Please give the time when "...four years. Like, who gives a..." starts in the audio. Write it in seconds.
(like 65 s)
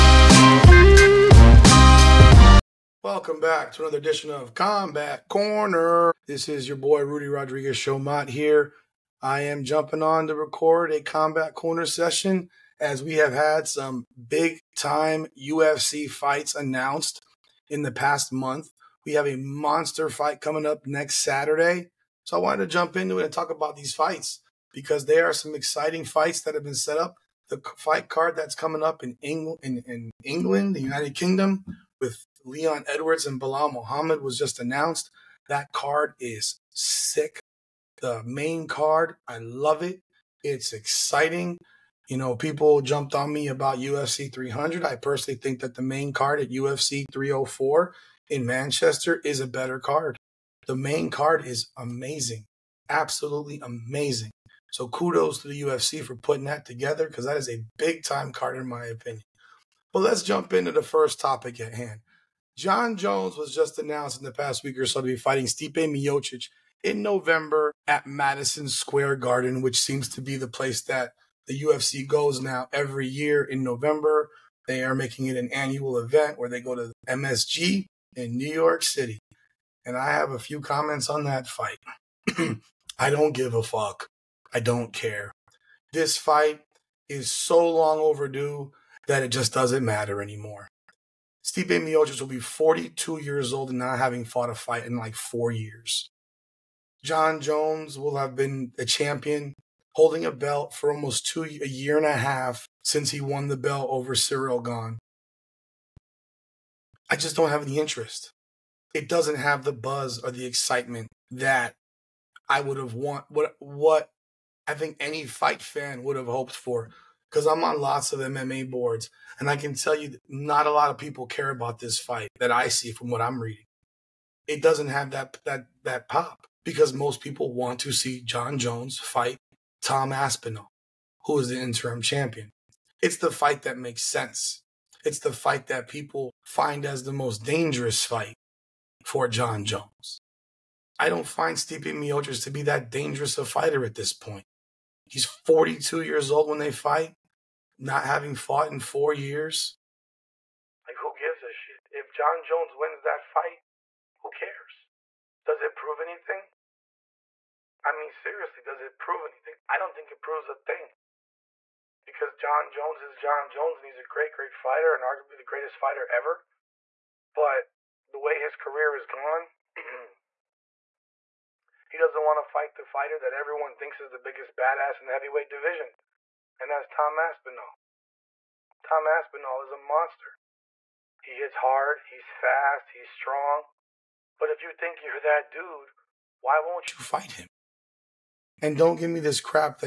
148 s.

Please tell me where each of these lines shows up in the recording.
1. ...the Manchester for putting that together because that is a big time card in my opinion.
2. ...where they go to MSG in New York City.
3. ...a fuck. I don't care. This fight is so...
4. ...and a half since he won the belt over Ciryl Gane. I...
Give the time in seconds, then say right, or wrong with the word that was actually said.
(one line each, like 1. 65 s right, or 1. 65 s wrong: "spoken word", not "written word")
1. 55 s wrong: "UFC", not "Manchester"
2. 76 s right
3. 83 s right
4. 101 s right.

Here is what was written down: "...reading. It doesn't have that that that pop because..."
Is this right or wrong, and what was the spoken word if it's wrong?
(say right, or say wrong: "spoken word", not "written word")
right.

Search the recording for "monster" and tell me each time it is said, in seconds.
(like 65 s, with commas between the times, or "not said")
19 s, 179 s.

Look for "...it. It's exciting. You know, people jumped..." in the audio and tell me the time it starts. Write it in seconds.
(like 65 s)
39 s.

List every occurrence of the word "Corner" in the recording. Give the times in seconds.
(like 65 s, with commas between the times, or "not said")
5 s, 11 s.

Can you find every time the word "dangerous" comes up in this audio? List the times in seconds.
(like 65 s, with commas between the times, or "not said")
137 s, 142 s.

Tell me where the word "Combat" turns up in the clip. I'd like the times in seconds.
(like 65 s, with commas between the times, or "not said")
4 s, 11 s.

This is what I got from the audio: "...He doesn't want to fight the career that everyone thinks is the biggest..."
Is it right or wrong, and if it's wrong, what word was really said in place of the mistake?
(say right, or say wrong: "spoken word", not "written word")
wrong: "fighter", not "career".